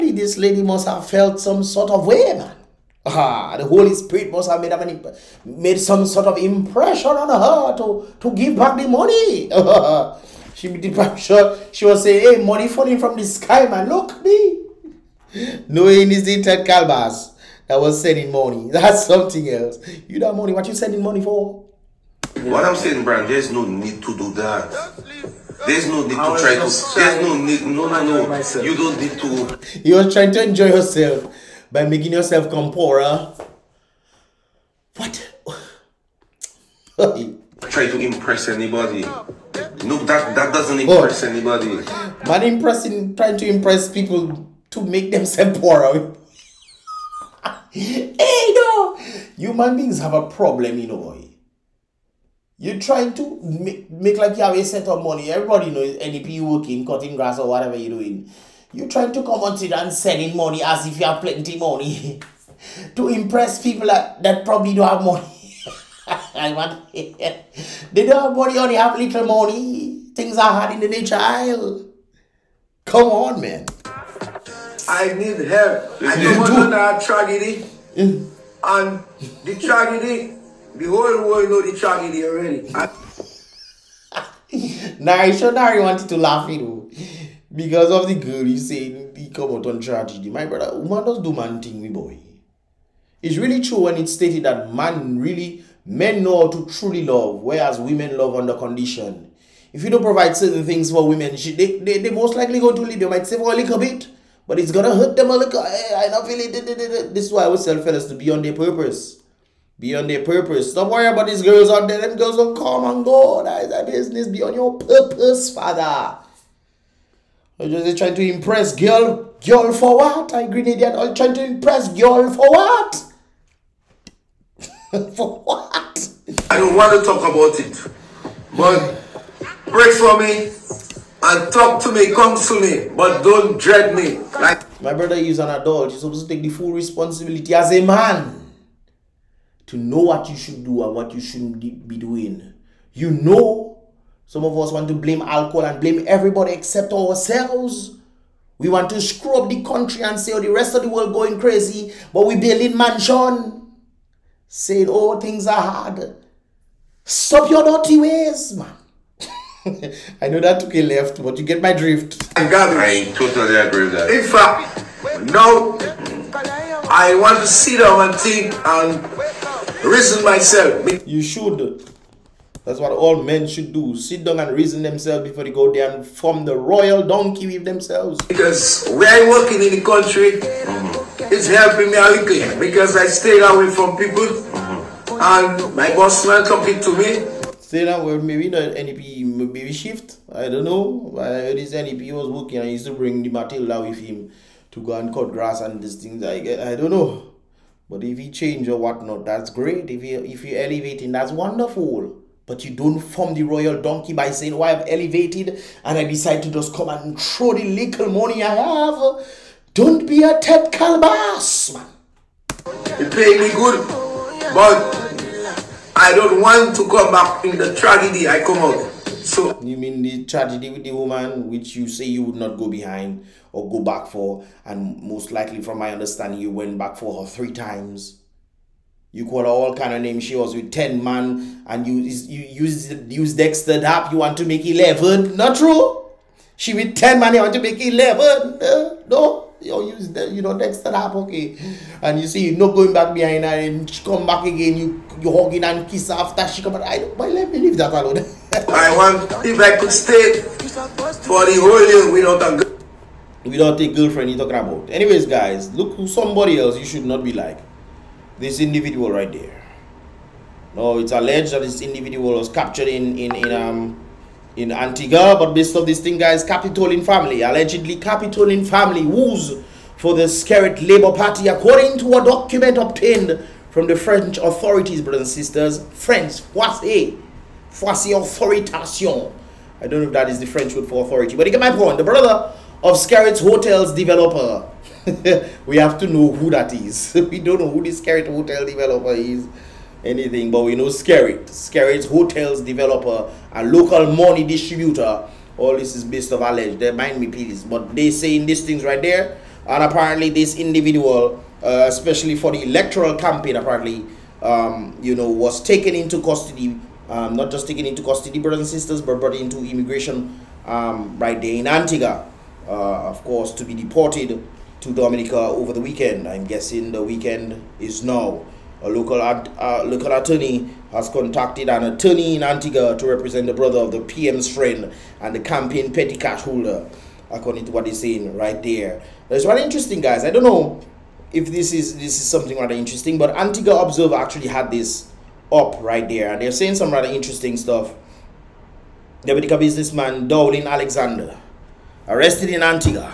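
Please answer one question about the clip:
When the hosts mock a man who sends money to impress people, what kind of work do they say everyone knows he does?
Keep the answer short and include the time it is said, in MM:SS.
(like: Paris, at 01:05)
cutting grass, at 00:56.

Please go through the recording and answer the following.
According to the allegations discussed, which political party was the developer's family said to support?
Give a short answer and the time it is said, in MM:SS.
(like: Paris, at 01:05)
Skerrit Labour Party, at 04:30.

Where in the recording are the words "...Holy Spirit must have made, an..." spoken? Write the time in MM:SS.
00:03.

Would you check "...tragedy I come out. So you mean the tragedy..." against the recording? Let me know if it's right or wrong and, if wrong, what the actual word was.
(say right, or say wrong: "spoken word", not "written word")
right.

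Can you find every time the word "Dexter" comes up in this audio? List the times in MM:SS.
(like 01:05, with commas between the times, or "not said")
03:53, 04:00.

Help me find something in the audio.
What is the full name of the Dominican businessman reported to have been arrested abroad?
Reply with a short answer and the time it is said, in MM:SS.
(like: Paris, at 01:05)
Dowling Alexander, at 05:40.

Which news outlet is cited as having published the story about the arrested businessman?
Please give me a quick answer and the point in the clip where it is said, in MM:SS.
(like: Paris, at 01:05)
Antigua Observer, at 05:33.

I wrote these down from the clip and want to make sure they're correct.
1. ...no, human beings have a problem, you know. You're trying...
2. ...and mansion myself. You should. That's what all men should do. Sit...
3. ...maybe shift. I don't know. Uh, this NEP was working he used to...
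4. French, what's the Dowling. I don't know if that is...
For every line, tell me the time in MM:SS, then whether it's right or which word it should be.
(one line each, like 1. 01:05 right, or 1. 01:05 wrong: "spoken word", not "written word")
1. 00:48 right
2. 02:48 wrong: "reason", not "mansion"
3. 03:09 right
4. 04:35 wrong: "Authoritation", not "Dowling".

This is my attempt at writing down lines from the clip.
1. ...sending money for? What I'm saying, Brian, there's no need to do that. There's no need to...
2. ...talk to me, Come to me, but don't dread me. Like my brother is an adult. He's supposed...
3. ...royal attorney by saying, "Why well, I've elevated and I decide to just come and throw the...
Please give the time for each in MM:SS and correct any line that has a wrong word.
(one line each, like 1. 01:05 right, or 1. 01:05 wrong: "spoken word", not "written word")
1. 00:20 right
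2. 02:11 right
3. 03:23 wrong: "donkey", not "attorney".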